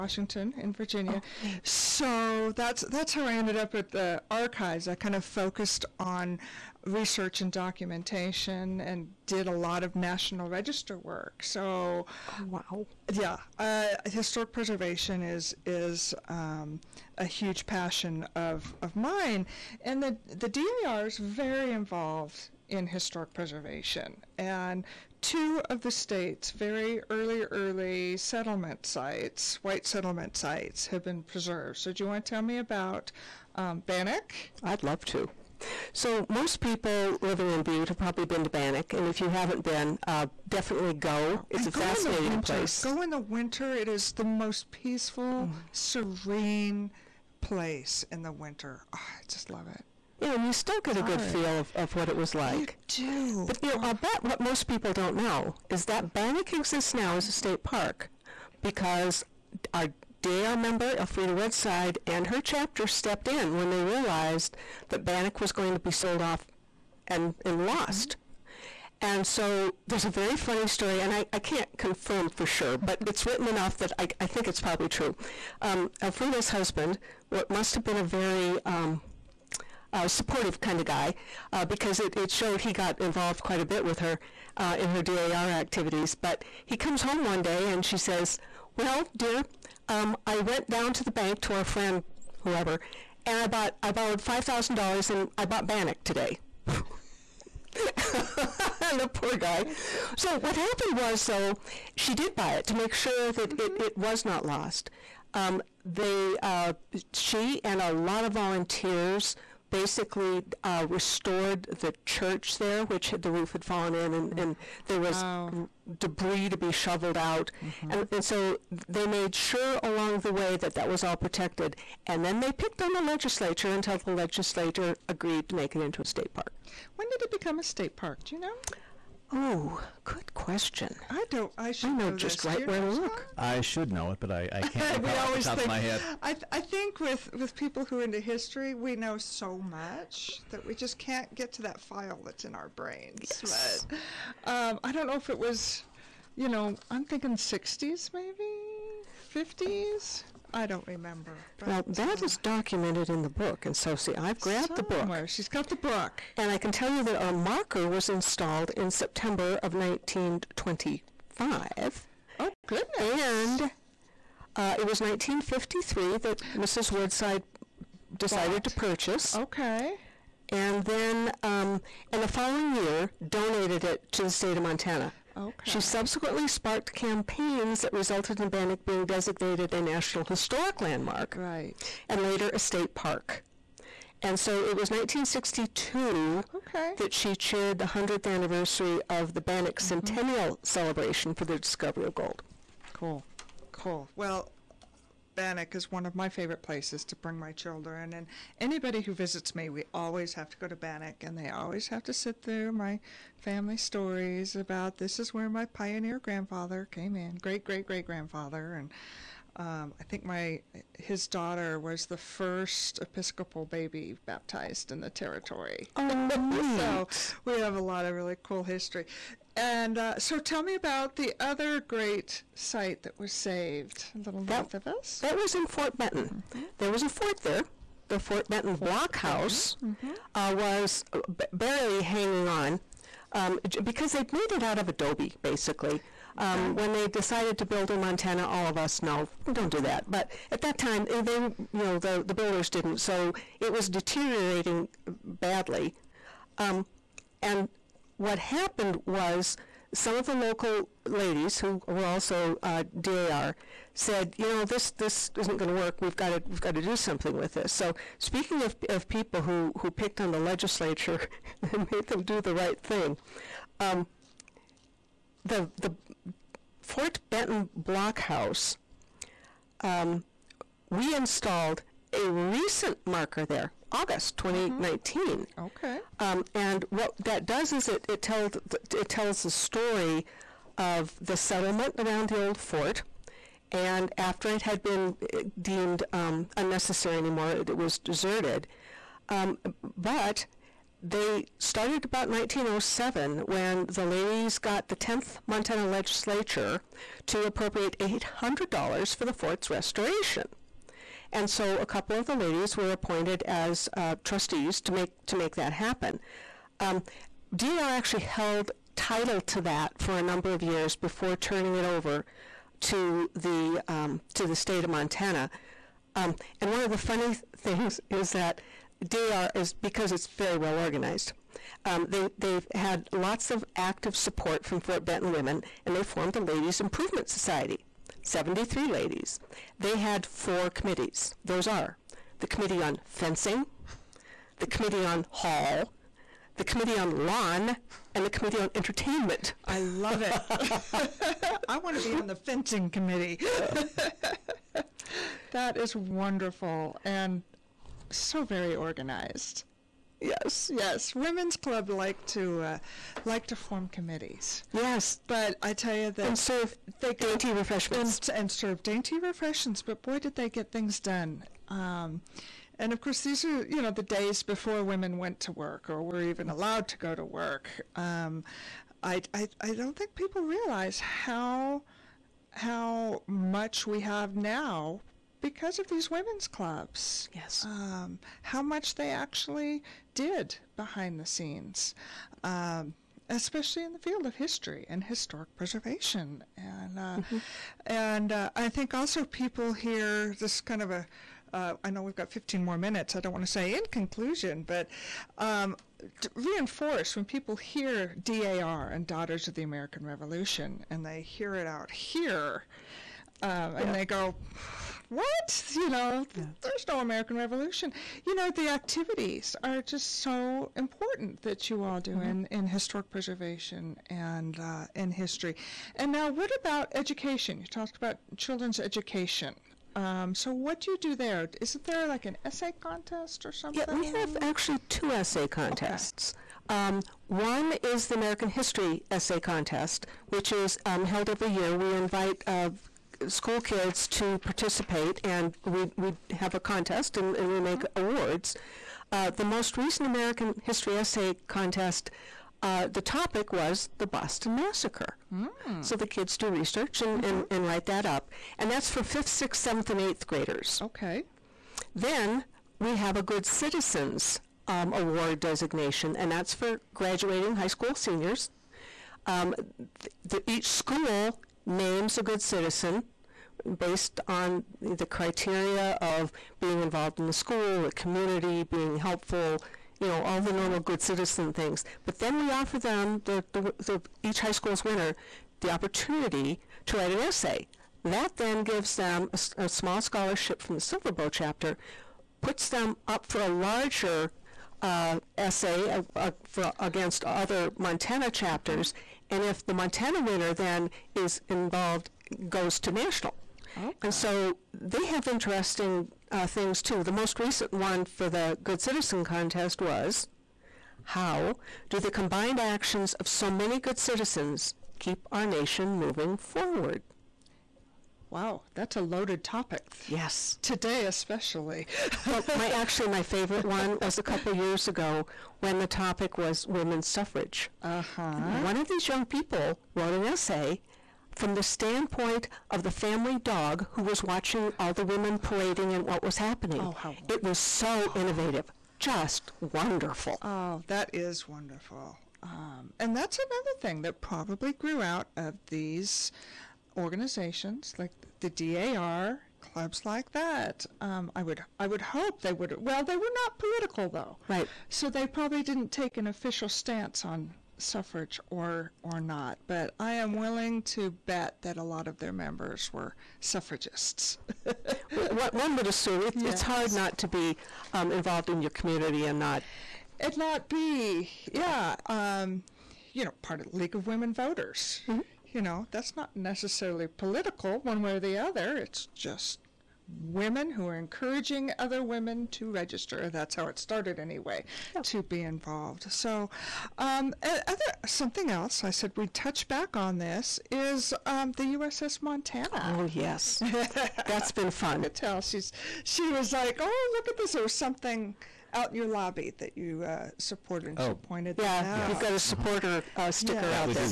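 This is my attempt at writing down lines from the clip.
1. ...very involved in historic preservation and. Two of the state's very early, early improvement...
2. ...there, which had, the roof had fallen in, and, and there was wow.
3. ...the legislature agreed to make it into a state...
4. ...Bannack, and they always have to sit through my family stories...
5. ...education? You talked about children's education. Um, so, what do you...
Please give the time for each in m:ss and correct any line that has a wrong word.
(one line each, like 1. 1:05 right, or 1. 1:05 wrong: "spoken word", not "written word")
1. 0:21 wrong: "settlement", not "improvement"
2. 1:52 right
3. 2:03 right
4. 3:20 right
5. 6:56 right.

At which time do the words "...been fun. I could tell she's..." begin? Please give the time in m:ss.
9:44.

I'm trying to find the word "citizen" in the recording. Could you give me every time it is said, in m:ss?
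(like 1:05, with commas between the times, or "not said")
7:33, 7:42, 7:51, 8:18, 8:23.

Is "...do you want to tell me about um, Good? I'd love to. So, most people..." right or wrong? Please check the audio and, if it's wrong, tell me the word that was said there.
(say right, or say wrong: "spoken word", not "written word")
wrong: "Bannack", not "Good".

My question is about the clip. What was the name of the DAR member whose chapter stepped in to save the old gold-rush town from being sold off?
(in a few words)
Elfrida Woodside.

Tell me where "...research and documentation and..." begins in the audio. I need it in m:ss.
0:06.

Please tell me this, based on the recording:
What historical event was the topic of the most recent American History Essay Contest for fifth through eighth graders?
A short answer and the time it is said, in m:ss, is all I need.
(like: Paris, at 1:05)
Boston Massacre, at 7:23.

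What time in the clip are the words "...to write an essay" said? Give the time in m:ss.
7:56.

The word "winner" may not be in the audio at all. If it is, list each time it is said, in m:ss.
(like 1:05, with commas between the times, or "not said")
7:54, 8:10.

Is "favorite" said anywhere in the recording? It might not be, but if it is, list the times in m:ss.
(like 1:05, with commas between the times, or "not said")
3:16, 8:33.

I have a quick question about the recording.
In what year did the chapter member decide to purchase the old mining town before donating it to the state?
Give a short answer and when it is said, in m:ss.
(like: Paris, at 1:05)
1953, at 2:45.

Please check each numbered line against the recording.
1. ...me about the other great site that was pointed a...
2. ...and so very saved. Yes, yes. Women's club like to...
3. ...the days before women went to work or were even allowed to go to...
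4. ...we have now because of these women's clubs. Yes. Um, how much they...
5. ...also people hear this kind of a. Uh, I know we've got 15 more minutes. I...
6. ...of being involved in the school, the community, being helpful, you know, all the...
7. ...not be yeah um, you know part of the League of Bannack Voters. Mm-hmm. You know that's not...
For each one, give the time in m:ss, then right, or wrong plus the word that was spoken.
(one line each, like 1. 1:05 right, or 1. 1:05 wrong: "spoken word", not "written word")
1. 3:40 wrong: "saved", not "pointed"
2. 5:47 wrong: "organized", not "saved"
3. 6:03 right
4. 6:13 right
5. 6:28 right
6. 7:46 right
7. 9:20 wrong: "Women", not "Bannack".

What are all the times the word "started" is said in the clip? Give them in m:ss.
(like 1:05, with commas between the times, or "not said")
4:51, 9:33.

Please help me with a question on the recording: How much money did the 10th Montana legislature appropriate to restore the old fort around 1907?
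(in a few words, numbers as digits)
$800.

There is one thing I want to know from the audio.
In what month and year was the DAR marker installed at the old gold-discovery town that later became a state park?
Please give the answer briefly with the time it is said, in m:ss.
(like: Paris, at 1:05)
September 1925, at 2:38.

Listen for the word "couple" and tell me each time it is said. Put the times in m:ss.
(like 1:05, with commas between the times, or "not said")
5:01, 8:34.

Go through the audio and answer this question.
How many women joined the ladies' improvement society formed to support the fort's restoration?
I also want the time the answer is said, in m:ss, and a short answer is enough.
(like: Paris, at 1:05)
73, at 5:28.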